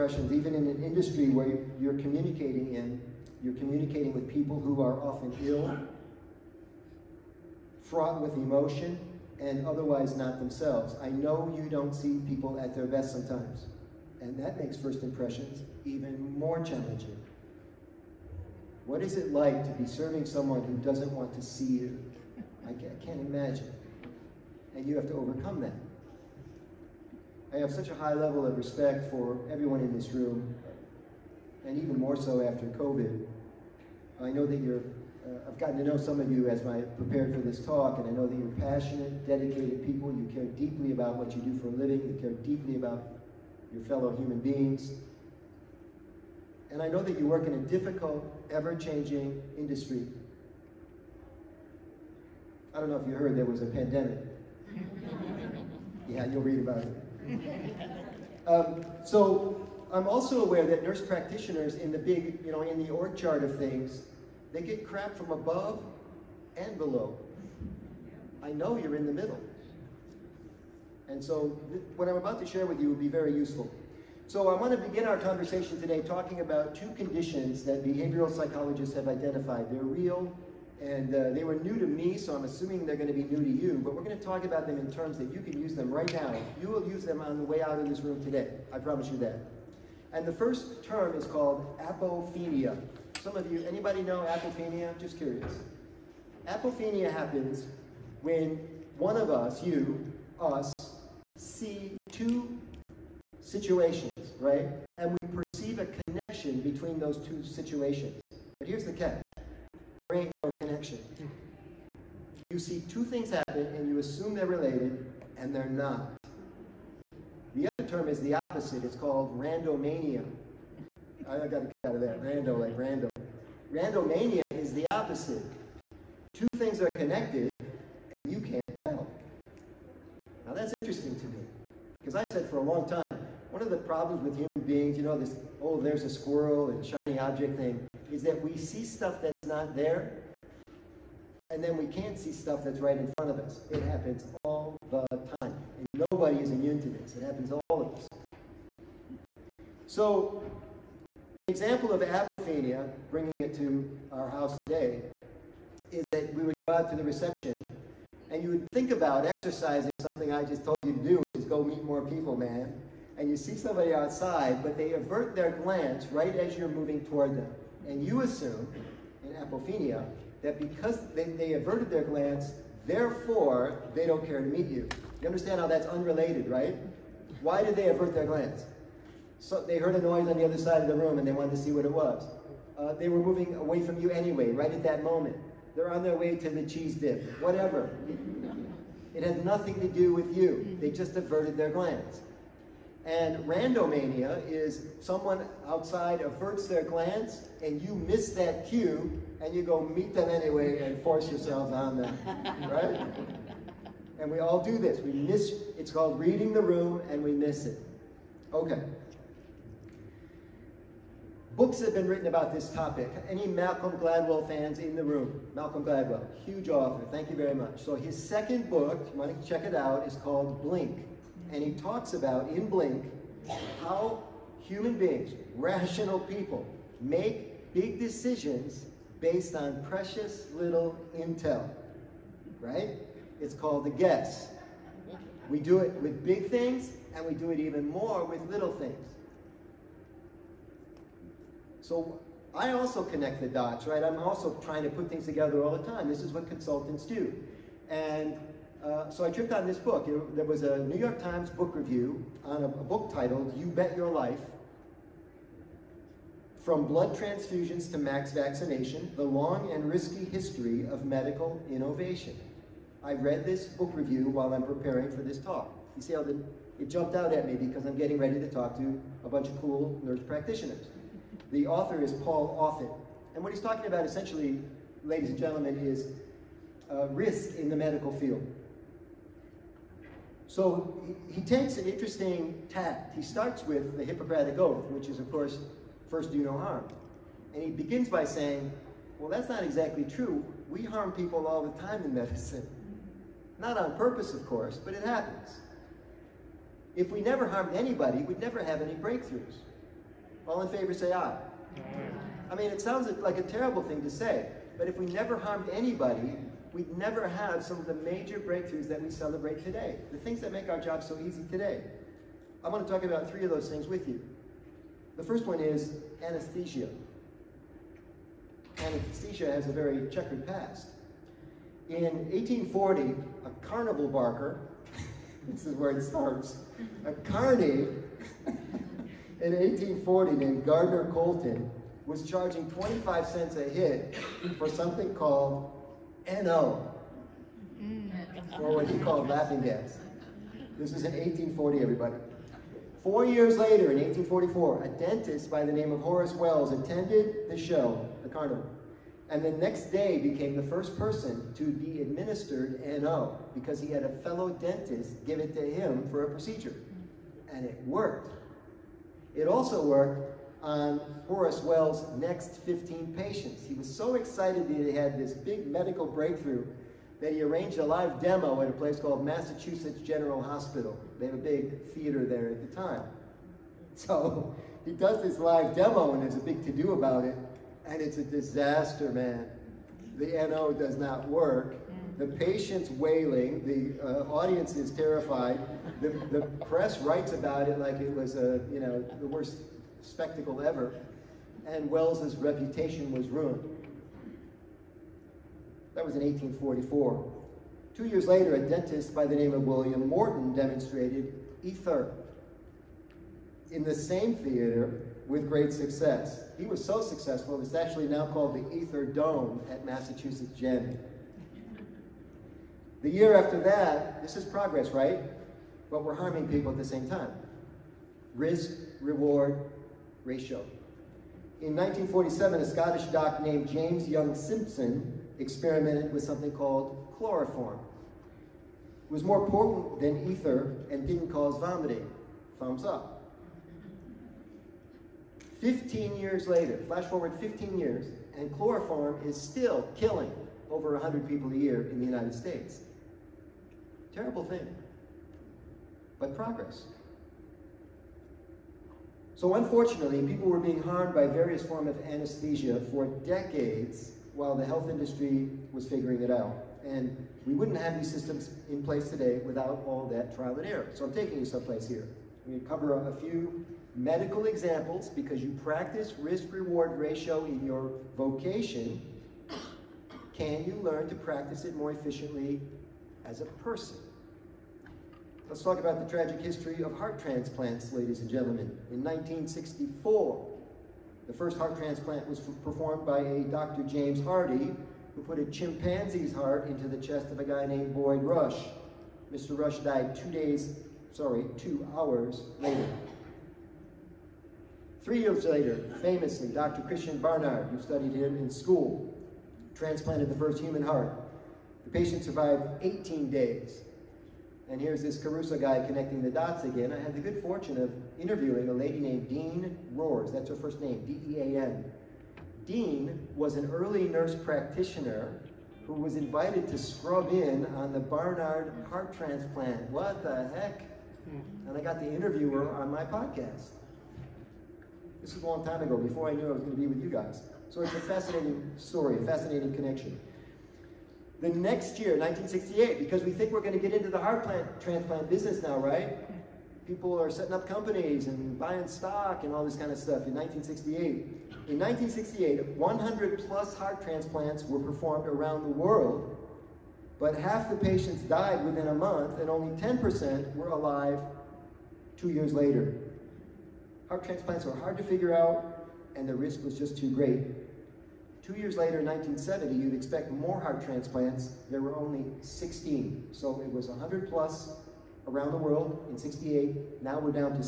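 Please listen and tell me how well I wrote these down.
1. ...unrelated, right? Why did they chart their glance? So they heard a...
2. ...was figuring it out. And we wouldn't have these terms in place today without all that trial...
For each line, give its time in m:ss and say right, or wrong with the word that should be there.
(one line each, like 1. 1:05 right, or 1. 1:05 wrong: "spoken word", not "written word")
1. 2:55 wrong: "avert", not "chart"
2. 7:35 wrong: "systems", not "terms".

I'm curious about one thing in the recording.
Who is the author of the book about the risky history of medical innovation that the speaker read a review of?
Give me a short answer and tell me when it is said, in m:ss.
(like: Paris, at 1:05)
Paul Offit, at 4:32.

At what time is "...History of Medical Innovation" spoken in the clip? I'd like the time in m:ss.
4:20.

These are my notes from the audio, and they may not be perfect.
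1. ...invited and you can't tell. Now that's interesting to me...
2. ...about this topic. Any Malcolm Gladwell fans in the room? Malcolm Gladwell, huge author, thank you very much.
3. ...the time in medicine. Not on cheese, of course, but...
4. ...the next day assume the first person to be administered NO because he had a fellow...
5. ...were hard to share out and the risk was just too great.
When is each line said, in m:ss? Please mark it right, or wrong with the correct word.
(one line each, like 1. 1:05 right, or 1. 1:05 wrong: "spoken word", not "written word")
1. 2:06 wrong: "connected", not "invited"
2. 3:32 right
3. 4:51 wrong: "purpose", not "cheese"
4. 5:49 wrong: "became", not "assume"
5. 9:14 wrong: "figure", not "share".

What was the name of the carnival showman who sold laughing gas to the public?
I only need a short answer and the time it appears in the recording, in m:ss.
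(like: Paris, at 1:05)
Gardner Colton, at 5:30.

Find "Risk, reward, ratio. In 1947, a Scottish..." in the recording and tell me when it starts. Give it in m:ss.
6:58.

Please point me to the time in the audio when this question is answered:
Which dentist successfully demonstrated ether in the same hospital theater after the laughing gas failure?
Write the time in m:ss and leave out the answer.
6:39.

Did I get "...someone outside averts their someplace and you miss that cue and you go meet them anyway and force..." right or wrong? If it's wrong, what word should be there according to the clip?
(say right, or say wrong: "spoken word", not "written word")
wrong: "glance", not "someplace".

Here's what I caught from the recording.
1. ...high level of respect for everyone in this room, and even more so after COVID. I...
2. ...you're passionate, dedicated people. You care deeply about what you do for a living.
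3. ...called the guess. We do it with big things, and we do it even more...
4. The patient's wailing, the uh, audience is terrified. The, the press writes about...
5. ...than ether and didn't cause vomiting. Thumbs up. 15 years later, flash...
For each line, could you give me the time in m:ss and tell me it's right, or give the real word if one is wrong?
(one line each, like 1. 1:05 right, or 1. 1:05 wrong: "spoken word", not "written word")
1. 0:27 right
2. 0:38 right
3. 3:53 right
4. 6:22 right
5. 7:10 right.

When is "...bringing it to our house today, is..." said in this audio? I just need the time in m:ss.
2:33.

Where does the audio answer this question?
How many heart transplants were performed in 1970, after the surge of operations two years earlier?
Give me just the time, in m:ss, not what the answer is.
9:22.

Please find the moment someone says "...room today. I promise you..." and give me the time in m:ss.
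1:28.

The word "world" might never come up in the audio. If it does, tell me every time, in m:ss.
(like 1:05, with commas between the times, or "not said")
9:05, 9:25.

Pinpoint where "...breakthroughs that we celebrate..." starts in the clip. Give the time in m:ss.
5:08.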